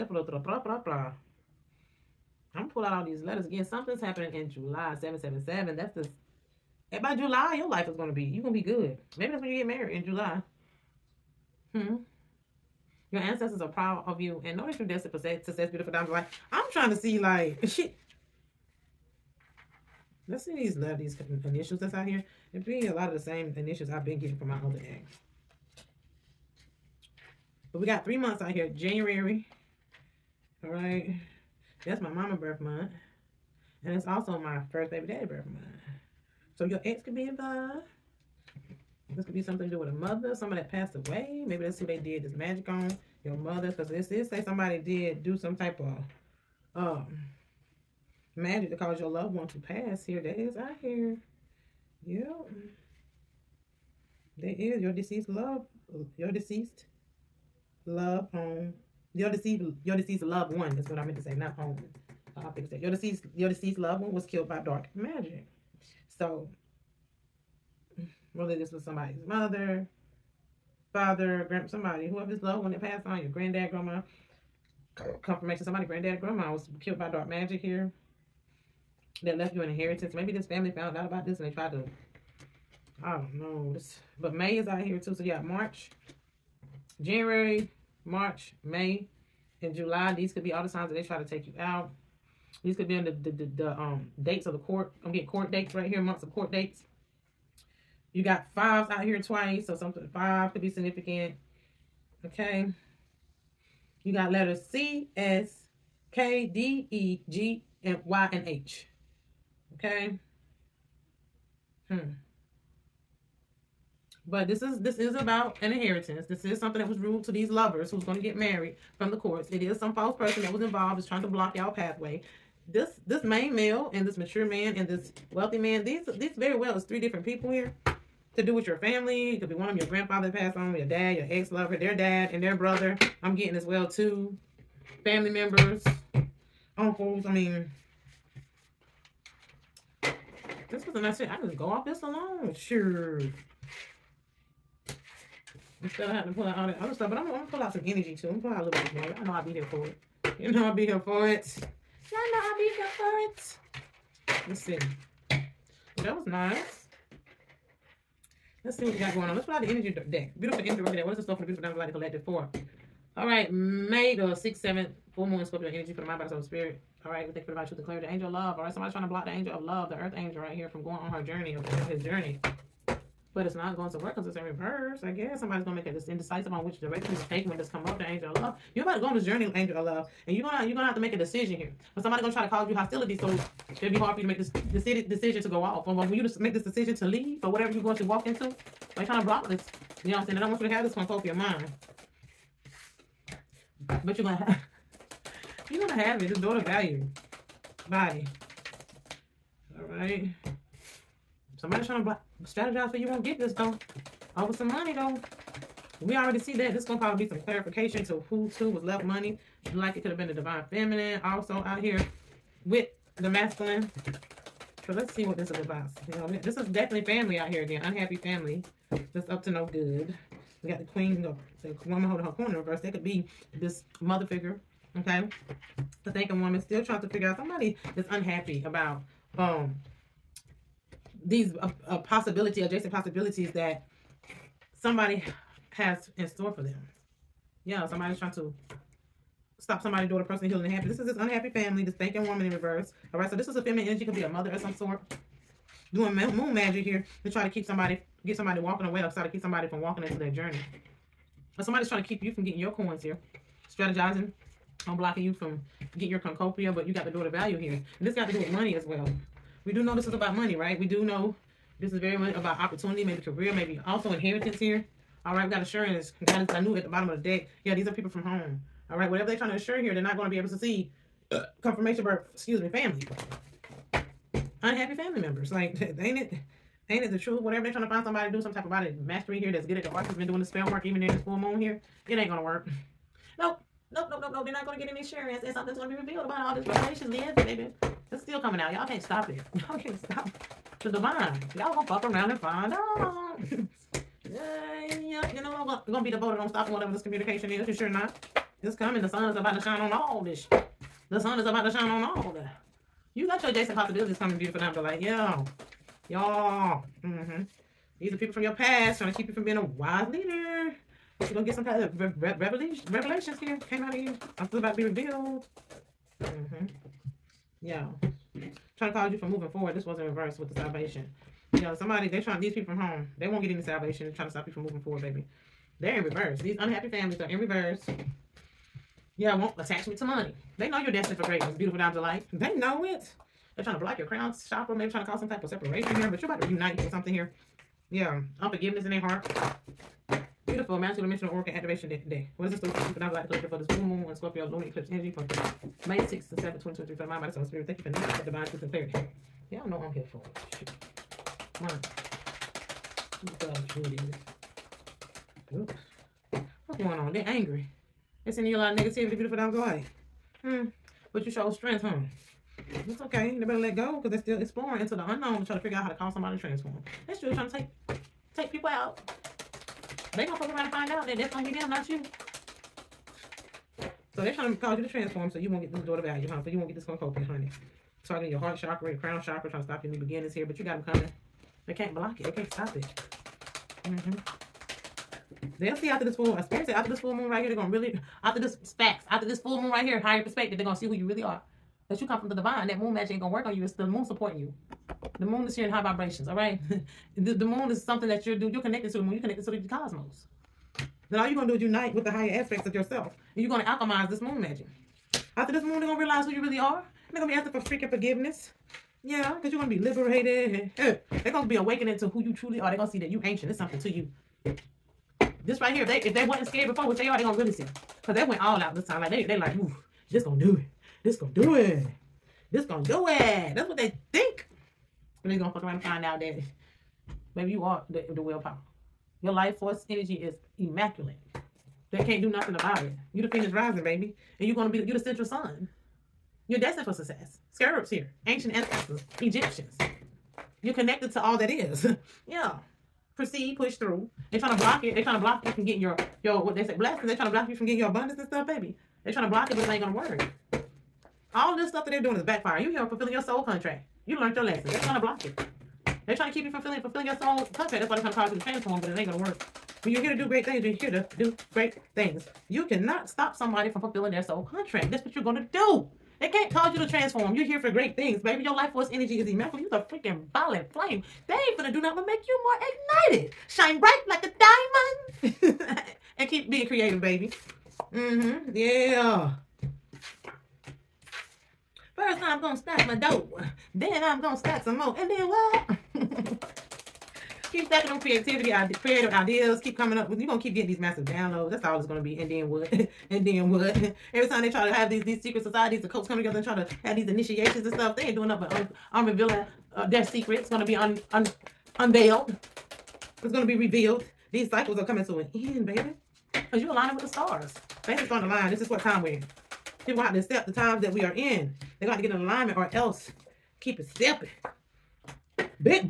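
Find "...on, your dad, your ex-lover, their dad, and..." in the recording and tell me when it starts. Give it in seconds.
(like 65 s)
130 s.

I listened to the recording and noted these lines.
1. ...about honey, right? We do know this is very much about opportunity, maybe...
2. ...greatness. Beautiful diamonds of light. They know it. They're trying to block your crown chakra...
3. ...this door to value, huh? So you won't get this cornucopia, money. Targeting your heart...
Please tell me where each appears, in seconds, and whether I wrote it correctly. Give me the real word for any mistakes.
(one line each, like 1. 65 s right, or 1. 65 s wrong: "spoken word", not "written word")
1. 260 s wrong: "money", not "honey"
2. 331 s right
3. 375 s wrong: "honey", not "money".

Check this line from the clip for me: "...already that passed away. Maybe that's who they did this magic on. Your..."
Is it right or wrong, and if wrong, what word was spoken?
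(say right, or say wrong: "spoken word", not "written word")
wrong: "somebody", not "already".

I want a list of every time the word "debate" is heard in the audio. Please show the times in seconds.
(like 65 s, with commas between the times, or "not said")
not said.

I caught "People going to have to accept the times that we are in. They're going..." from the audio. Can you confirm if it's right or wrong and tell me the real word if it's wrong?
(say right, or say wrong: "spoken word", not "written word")
right.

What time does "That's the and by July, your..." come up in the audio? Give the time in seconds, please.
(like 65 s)
5 s.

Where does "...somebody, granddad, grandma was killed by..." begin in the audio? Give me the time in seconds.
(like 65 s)
75 s.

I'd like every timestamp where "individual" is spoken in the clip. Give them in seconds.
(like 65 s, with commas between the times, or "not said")
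not said.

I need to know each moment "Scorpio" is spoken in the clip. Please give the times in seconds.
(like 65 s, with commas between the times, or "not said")
165 s, 344 s.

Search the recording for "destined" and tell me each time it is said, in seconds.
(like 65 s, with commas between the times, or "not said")
14 s, 330 s, 436 s.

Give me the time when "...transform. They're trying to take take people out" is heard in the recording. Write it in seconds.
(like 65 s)
366 s.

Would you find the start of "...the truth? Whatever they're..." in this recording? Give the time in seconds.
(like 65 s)
277 s.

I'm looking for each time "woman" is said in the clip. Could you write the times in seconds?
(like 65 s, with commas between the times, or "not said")
221 s, 226 s, 242 s.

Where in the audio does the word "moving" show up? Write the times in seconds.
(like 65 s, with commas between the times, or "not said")
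319 s, 324 s.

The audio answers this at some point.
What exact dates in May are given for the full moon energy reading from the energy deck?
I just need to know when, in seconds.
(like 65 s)
163 s.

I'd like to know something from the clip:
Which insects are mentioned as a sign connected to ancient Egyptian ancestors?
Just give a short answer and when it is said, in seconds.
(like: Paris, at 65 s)
Scarabs, at 437 s.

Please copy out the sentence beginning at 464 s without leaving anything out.
That's what you're going to do.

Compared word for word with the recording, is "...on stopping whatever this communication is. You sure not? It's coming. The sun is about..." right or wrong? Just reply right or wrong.
right.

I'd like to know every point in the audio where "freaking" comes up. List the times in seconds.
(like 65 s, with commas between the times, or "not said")
407 s, 469 s.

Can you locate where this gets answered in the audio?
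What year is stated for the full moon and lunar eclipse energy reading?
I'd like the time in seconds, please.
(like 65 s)
346 s.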